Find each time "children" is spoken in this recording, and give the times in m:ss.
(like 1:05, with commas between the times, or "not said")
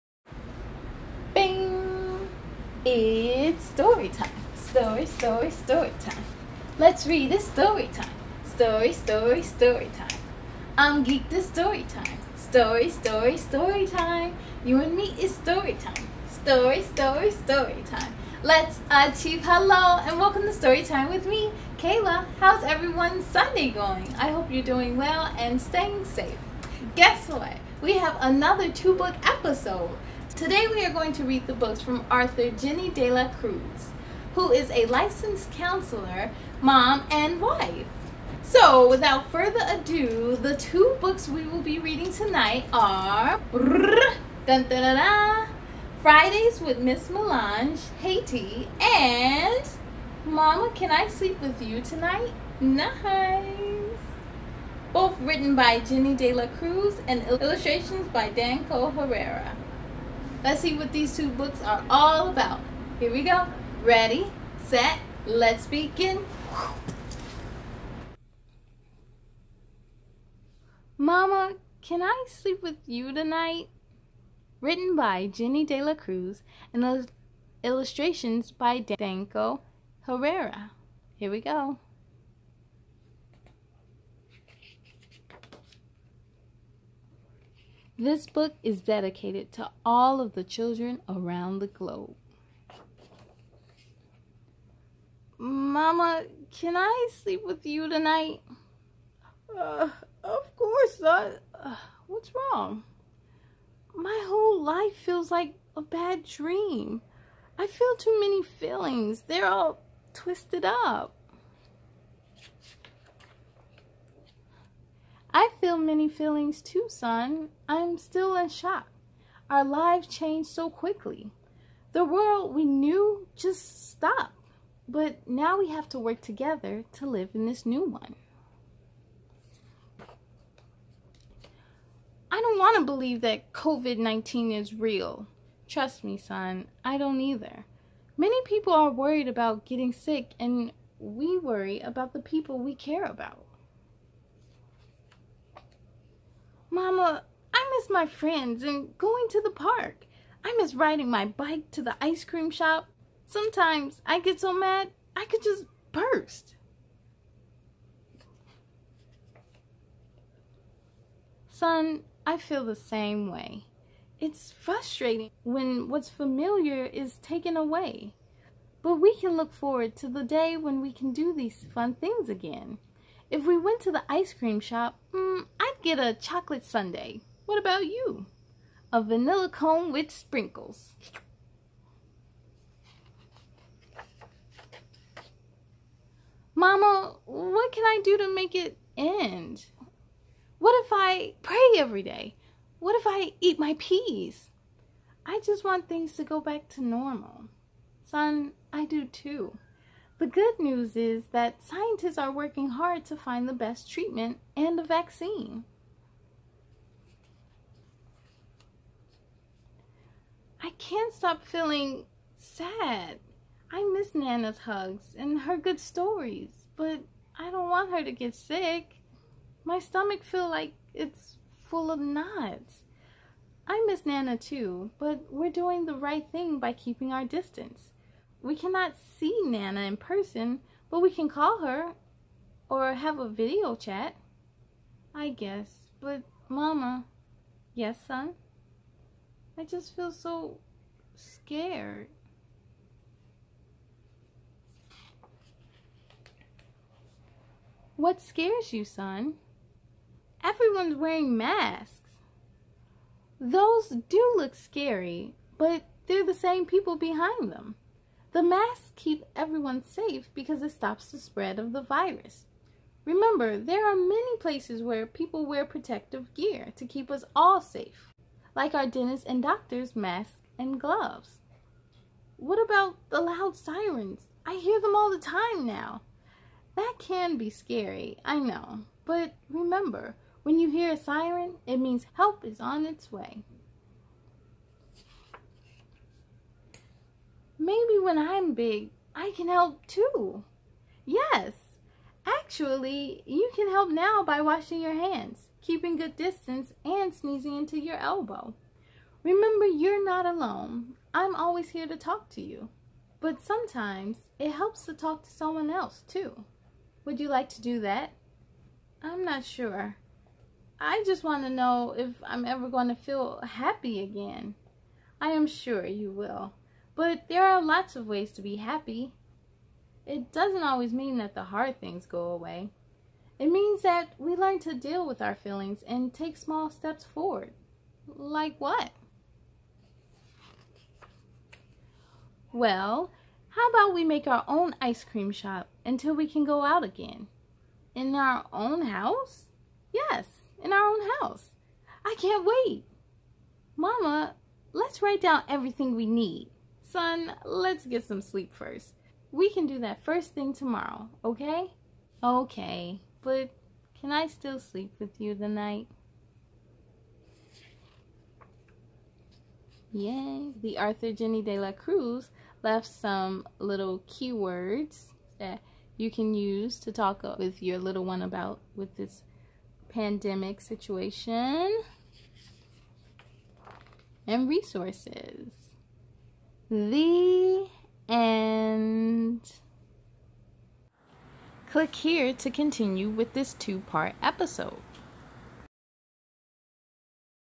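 1:30.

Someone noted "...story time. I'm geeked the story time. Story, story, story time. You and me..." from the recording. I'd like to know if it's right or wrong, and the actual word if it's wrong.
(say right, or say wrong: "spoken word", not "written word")
right.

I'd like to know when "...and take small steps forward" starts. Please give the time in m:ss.
5:25.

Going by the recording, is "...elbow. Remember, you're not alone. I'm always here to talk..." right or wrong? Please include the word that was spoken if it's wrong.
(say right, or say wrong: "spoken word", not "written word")
right.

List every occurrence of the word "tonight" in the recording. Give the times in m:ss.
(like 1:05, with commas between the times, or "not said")
0:42, 0:51, 1:13, 1:37.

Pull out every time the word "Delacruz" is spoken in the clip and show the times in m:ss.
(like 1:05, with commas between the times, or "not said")
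0:32, 0:56, 1:15, 6:01.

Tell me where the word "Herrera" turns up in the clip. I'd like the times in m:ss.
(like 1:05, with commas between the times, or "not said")
0:58, 1:20.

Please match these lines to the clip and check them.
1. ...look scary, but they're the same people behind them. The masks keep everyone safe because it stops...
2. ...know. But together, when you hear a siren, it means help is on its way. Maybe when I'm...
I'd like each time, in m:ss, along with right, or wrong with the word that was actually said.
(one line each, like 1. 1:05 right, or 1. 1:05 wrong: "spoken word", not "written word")
1. 4:14 right
2. 4:38 wrong: "remember", not "together".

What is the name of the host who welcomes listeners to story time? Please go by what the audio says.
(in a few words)
Kayla.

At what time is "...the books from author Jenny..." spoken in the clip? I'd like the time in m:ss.
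0:31.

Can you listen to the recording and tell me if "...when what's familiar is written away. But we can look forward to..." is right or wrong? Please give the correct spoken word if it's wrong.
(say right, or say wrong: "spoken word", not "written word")
wrong: "taken", not "written".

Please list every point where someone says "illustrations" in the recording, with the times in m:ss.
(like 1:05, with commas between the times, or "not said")
0:57, 1:17.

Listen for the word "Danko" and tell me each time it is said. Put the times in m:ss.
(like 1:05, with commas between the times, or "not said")
0:58, 1:18.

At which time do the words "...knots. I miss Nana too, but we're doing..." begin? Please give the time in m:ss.
3:41.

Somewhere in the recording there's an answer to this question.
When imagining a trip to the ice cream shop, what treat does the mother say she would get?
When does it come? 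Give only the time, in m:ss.
2:56.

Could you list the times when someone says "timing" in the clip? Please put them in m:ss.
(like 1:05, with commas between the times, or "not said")
not said.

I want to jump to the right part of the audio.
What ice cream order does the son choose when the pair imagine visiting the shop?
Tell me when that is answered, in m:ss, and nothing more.
2:59.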